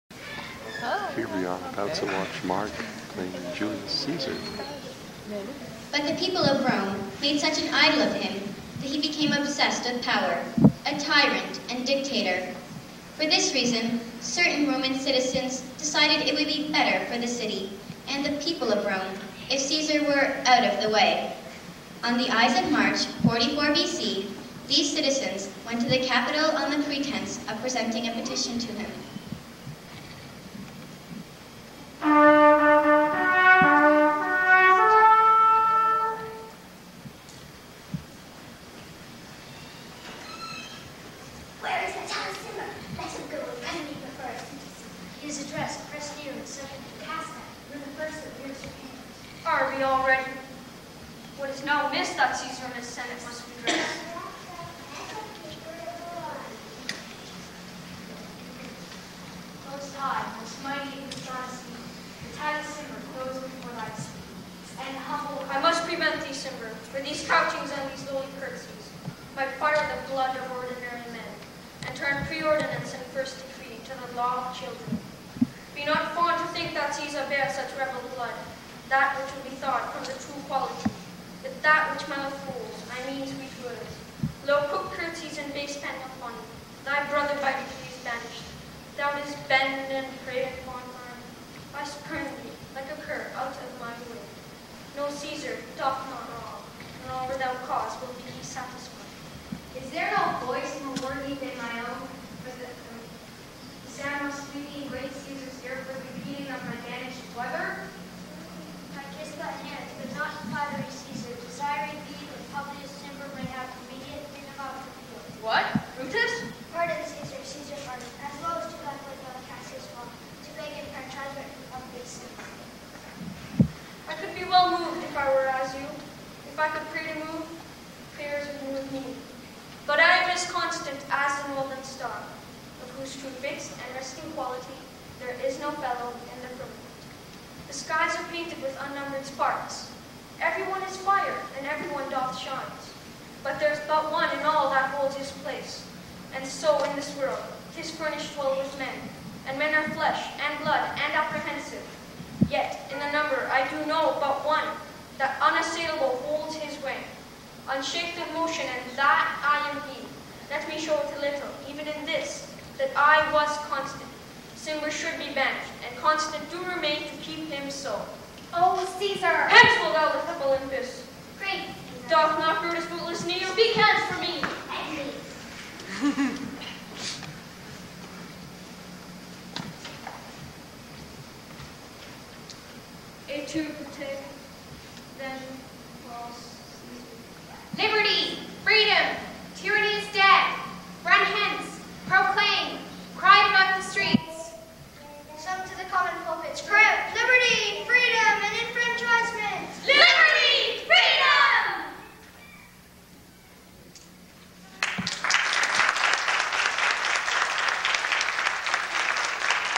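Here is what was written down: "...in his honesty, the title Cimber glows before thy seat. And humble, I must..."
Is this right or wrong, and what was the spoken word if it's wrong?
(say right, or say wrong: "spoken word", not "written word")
right.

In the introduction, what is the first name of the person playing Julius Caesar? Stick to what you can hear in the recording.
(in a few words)
Mark.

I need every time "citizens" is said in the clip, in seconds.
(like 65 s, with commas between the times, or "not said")
14 s, 24 s.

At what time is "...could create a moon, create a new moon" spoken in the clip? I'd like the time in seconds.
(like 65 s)
126 s.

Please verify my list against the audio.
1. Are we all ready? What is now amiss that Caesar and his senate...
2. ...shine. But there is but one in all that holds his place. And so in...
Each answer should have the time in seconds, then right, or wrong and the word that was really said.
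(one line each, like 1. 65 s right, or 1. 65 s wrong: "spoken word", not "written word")
1. 49 s right
2. 142 s right.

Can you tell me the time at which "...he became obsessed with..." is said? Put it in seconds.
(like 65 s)
8 s.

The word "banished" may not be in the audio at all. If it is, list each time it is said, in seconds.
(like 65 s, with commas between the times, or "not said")
88 s, 165 s.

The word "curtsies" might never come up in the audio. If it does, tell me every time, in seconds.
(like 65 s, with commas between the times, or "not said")
68 s, 84 s.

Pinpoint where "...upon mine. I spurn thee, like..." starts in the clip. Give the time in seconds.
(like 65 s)
90 s.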